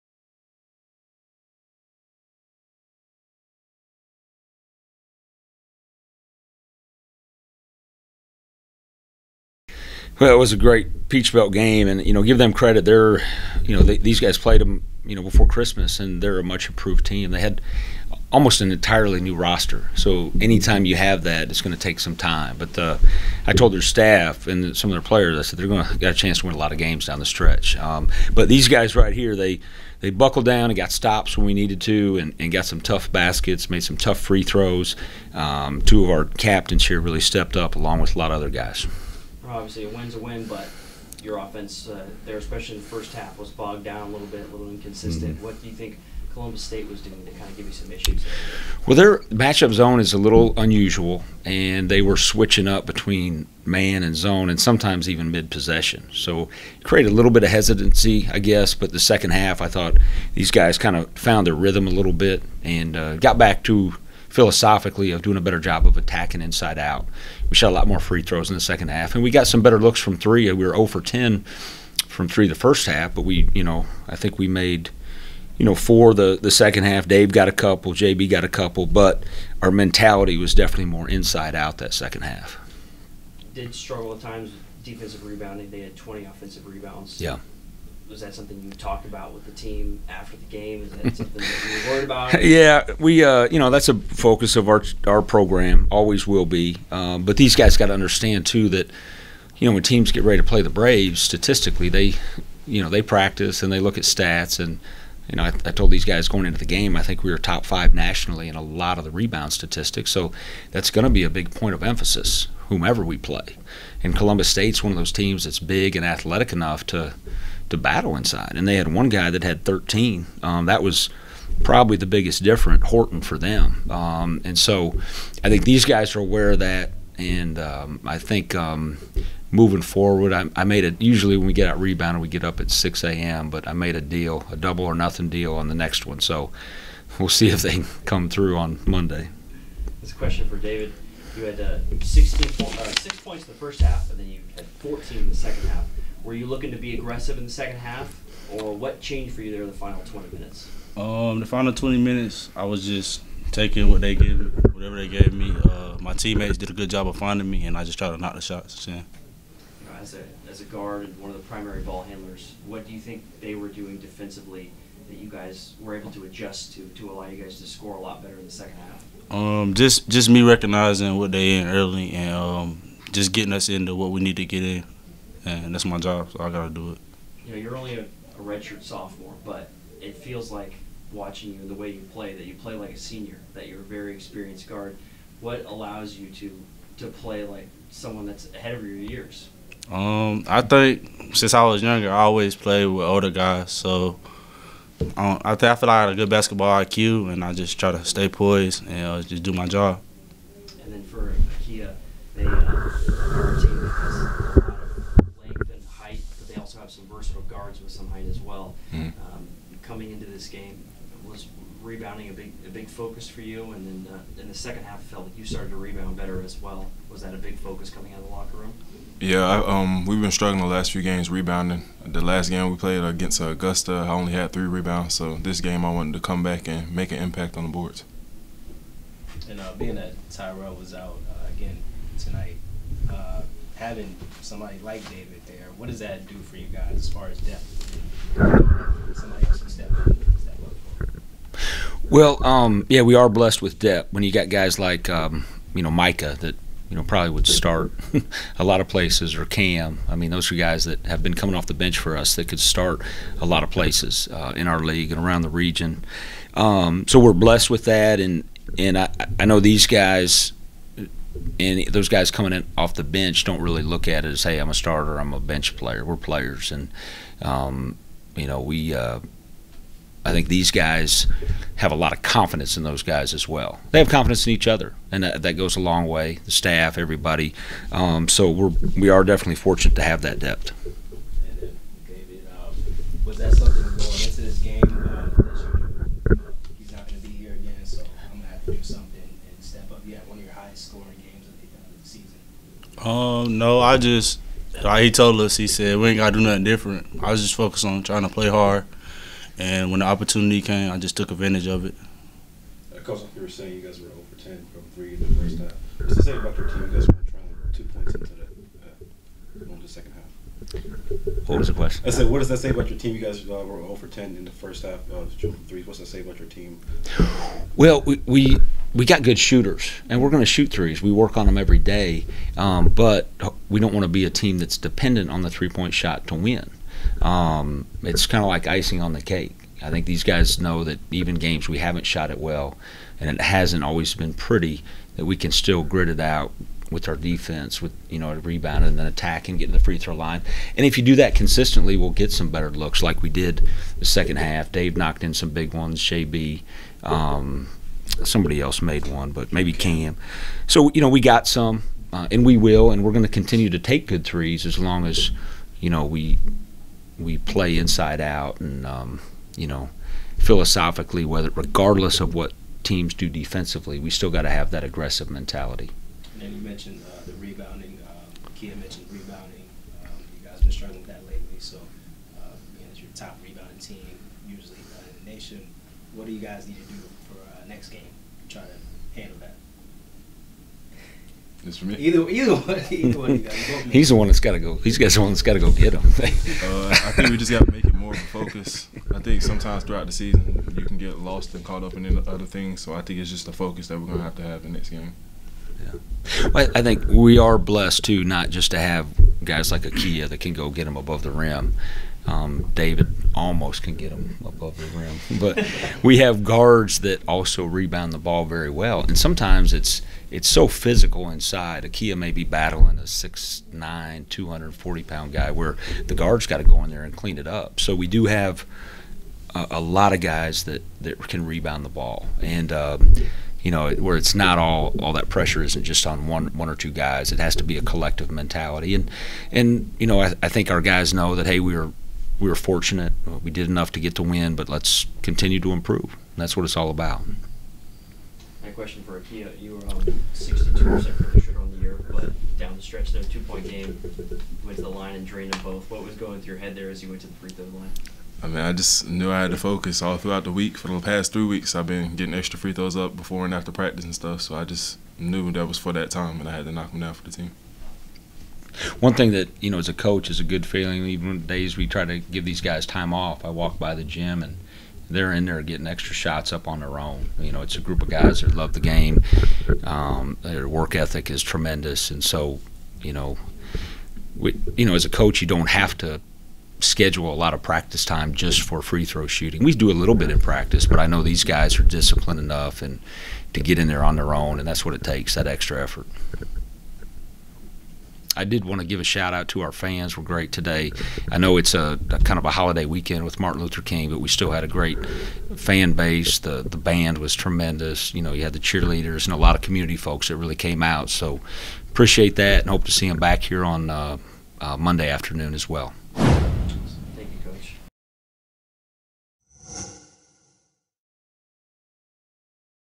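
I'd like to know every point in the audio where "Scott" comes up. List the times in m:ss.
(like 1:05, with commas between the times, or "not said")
not said.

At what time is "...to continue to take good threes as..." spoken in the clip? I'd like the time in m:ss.
5:53.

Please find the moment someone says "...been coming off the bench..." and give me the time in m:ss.
4:11.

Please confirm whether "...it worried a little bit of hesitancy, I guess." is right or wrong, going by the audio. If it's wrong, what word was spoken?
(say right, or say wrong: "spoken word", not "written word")
wrong: "created", not "worried".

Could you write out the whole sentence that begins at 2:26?
Were you looking to be aggressive in the second half, or what changed for you there in the final 20 minutes?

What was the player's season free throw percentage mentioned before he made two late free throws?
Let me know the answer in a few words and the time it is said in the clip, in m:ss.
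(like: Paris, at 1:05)
62%, at 7:20.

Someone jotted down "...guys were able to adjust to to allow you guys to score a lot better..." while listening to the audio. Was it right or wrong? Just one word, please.
right.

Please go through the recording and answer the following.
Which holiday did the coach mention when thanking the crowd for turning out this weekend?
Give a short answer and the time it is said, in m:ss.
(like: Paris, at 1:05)
Martin Luther King, at 8:13.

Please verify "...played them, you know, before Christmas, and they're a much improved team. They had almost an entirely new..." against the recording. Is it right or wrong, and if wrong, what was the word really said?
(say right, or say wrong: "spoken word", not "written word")
right.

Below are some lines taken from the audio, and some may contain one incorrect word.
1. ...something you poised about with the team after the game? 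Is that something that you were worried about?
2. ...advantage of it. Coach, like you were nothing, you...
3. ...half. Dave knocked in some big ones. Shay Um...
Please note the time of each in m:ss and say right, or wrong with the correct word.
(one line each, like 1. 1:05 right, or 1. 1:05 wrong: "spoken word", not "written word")
1. 1:28 wrong: "talked", not "poised"
2. 5:01 wrong: "saying", not "nothing"
3. 5:44 right.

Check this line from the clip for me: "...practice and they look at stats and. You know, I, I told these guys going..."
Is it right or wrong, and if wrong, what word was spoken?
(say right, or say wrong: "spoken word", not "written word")
right.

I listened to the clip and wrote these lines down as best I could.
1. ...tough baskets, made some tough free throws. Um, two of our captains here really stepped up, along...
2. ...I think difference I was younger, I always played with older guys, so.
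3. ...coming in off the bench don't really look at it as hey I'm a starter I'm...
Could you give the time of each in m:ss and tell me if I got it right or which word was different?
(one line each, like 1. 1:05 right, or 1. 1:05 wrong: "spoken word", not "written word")
1. 0:32 right
2. 3:10 wrong: "since", not "difference"
3. 4:22 right.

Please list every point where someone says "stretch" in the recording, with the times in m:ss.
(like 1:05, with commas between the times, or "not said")
0:27, 7:22.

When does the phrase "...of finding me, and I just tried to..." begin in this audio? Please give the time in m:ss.
2:37.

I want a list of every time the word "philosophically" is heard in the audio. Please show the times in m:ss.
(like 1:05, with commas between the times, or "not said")
1:04, 6:00.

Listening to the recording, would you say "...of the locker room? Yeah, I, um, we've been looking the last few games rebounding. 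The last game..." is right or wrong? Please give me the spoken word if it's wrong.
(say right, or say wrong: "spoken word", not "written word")
wrong: "struggling", not "looking".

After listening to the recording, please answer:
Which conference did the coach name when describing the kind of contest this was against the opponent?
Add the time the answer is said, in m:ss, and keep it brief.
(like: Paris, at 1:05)
Peach Belt, at 0:11.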